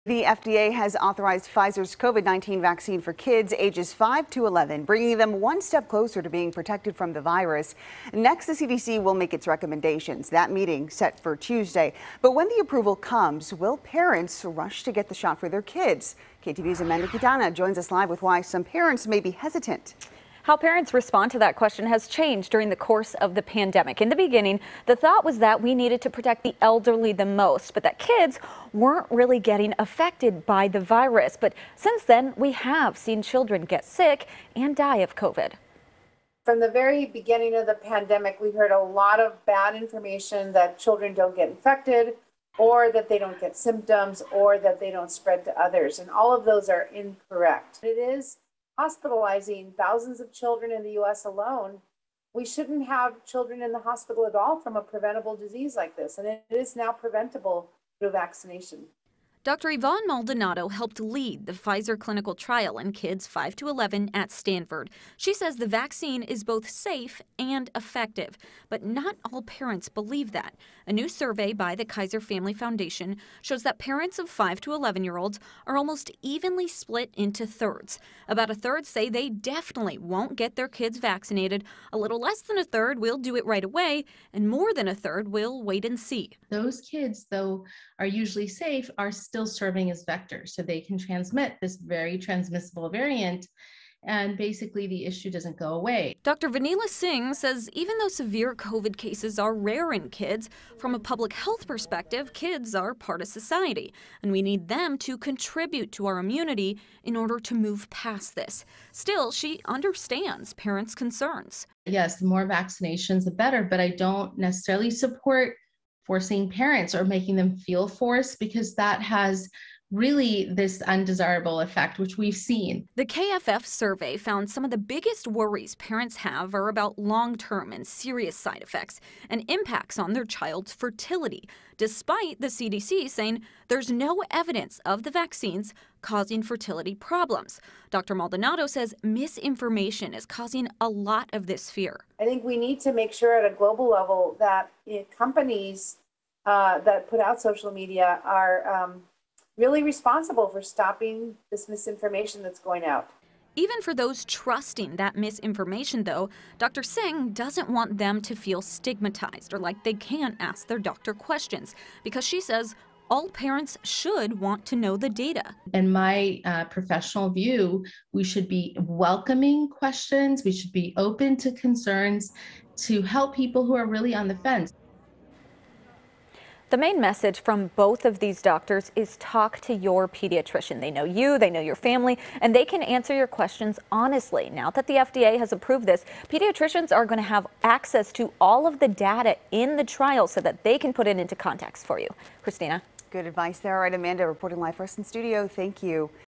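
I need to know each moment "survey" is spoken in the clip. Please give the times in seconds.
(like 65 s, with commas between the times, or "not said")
71 s, 123 s.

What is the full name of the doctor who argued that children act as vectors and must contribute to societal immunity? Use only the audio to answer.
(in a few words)
Dr. Vanila Singh.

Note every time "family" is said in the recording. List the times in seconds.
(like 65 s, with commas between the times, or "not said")
72 s, 181 s.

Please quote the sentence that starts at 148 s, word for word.
Um, really responsible for stopping this misinformation that's going out.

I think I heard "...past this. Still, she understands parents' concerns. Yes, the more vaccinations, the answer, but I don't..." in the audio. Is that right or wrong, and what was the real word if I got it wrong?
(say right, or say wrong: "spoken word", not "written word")
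wrong: "better", not "answer".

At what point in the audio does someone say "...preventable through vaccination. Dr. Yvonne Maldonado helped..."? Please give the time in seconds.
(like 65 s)
56 s.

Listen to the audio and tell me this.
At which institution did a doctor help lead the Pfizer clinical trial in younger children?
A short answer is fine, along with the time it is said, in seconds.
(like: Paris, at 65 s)
Stanford, at 64 s.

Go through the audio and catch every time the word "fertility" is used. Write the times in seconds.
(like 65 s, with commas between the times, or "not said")
130 s, 136 s.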